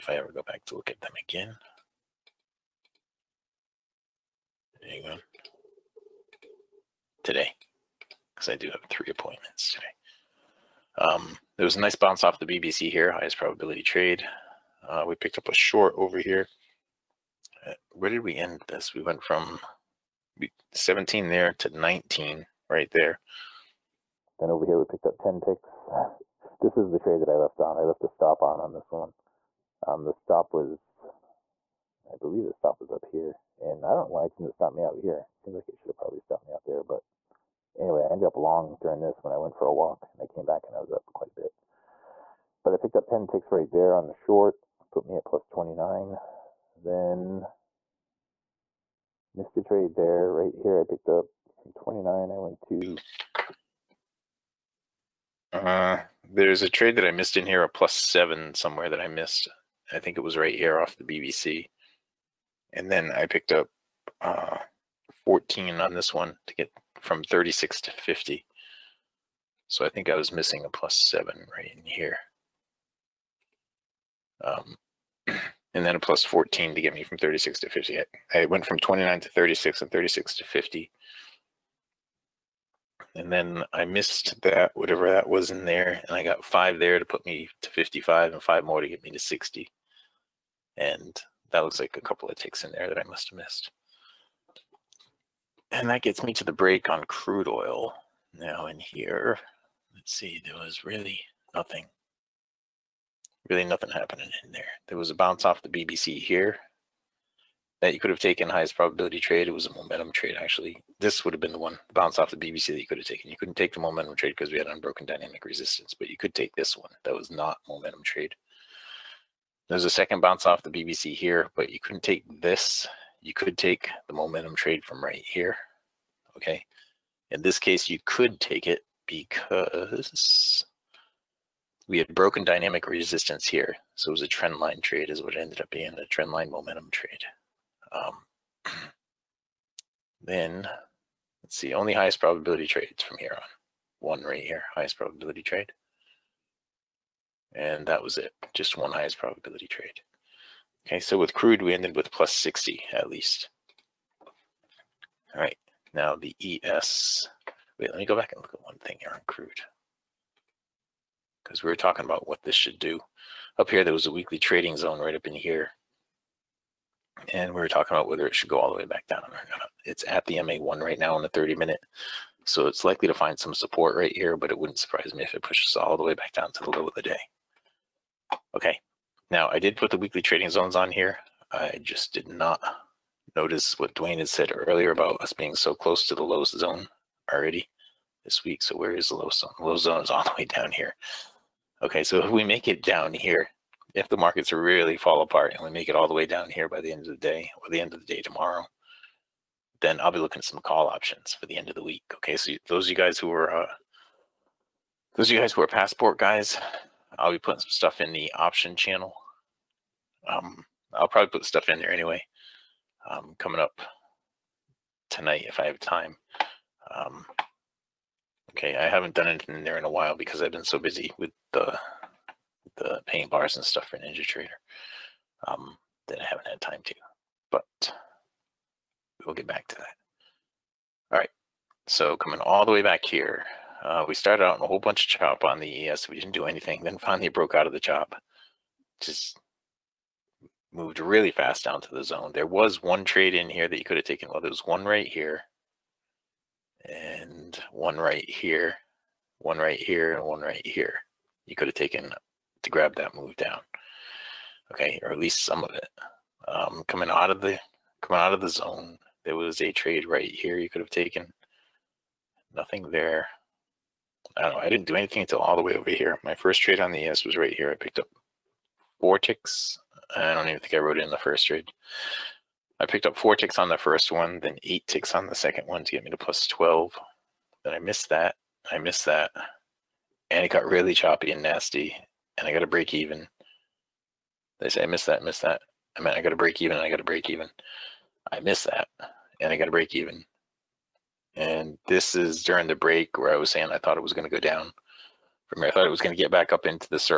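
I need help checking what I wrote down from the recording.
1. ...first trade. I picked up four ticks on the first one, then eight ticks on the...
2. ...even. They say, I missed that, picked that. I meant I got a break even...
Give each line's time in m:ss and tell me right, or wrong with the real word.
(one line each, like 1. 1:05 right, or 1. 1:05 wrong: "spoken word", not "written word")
1. 4:31 right
2. 4:42 wrong: "missed", not "picked".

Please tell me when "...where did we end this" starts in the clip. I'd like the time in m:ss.
0:17.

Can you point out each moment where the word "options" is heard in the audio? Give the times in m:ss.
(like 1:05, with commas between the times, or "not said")
3:20, 3:28.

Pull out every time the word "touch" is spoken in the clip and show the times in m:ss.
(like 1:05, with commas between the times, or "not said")
not said.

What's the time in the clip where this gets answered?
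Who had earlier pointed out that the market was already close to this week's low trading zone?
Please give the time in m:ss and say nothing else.
3:03.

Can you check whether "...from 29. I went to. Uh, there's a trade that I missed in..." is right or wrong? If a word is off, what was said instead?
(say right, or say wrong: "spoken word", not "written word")
right.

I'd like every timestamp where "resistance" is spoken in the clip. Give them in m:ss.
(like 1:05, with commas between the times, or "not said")
1:55, 2:12.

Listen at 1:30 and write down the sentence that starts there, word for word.
And that looks like a couple of ticks in there that I must have missed.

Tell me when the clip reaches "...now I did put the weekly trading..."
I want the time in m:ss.
2:59.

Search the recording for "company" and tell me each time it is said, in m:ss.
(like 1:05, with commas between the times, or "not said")
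not said.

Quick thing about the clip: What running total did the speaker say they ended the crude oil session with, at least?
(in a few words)
plus 60.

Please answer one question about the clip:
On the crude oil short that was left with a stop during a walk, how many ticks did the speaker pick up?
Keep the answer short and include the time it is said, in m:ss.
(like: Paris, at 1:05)
10, at 0:42.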